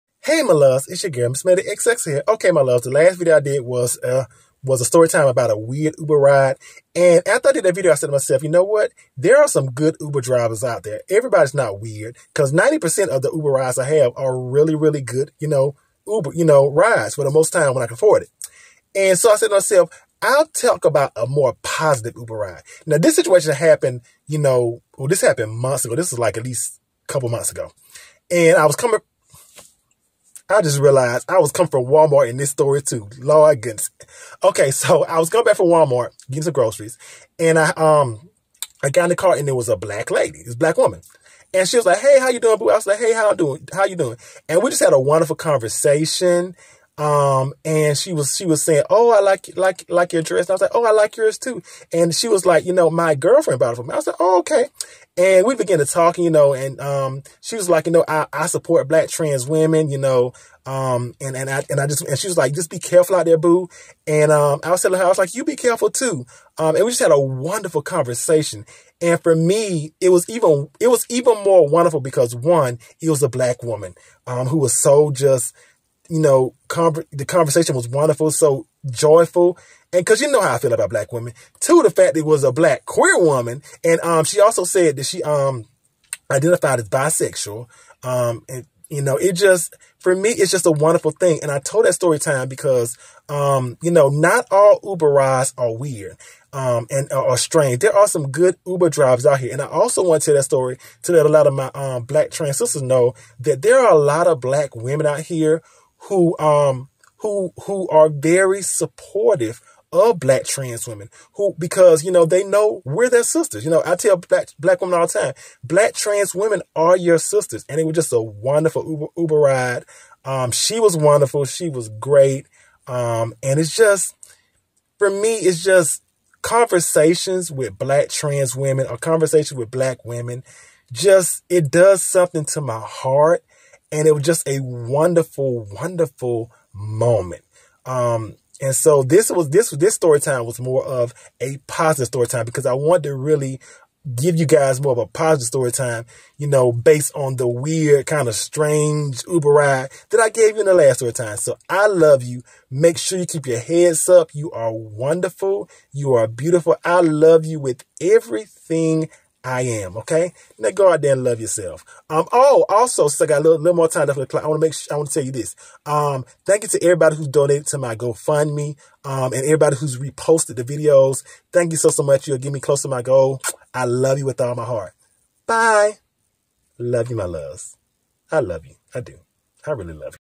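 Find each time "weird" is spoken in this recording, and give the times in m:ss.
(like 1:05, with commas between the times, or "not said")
0:05, 0:11, 1:35, 2:27.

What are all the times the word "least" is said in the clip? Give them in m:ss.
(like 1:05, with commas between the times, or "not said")
0:26.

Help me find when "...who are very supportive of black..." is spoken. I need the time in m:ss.
1:47.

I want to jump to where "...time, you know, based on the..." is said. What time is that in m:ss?
2:25.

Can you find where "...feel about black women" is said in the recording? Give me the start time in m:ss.
1:20.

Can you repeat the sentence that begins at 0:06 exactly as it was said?
And after I did that video, I said to myself, you know what?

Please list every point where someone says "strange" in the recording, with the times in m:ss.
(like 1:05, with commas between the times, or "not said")
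1:37, 2:28.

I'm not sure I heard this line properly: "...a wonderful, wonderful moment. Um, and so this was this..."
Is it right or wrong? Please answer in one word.
right.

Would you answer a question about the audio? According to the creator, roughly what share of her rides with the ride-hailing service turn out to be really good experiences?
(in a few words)
90%.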